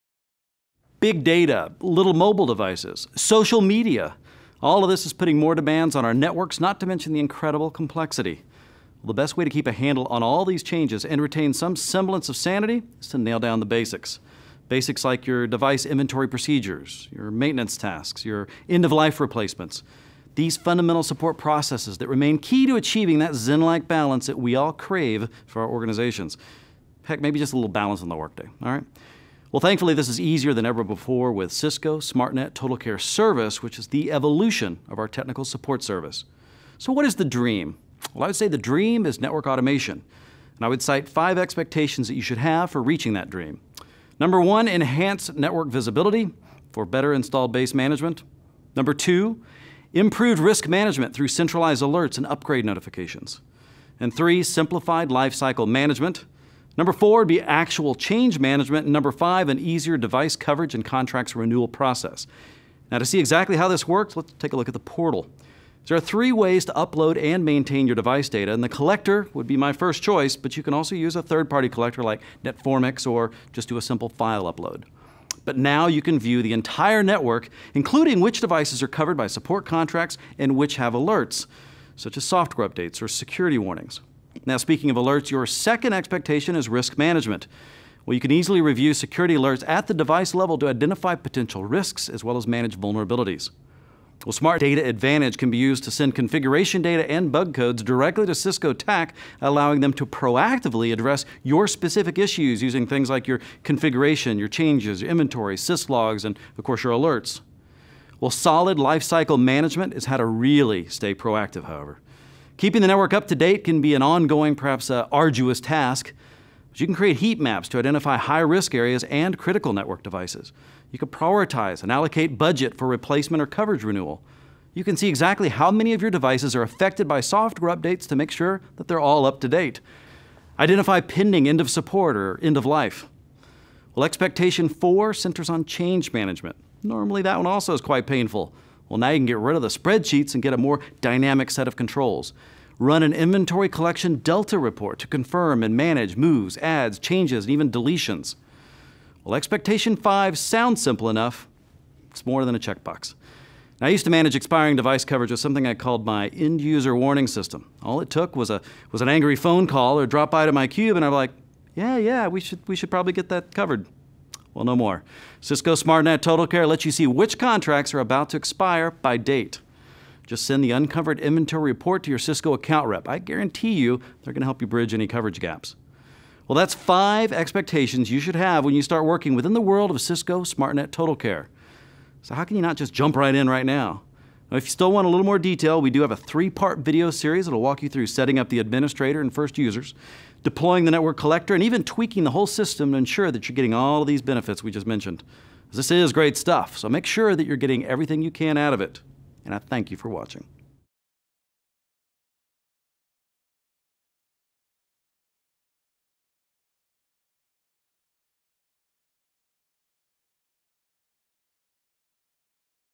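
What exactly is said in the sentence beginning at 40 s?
And I would cite five expectations that you should have for reaching that dream.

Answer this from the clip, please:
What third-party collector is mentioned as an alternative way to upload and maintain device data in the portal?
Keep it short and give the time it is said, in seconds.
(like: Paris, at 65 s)
Netformx, at 72 s.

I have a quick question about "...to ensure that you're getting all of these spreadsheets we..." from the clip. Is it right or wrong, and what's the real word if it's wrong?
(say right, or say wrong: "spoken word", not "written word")
wrong: "benefits", not "spreadsheets".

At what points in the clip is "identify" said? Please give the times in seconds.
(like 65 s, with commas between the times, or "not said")
90 s, 117 s, 130 s.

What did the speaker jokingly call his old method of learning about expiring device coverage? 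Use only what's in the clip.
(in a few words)
End user warning system.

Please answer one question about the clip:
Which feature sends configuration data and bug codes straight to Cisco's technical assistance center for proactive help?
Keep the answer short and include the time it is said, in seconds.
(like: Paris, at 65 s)
Smart Data Advantage, at 94 s.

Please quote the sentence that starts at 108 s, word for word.
Well, solid lifecycle management is how to really stay proactive, however.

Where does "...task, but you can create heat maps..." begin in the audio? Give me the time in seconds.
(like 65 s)
115 s.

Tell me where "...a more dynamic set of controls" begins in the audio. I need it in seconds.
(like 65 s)
140 s.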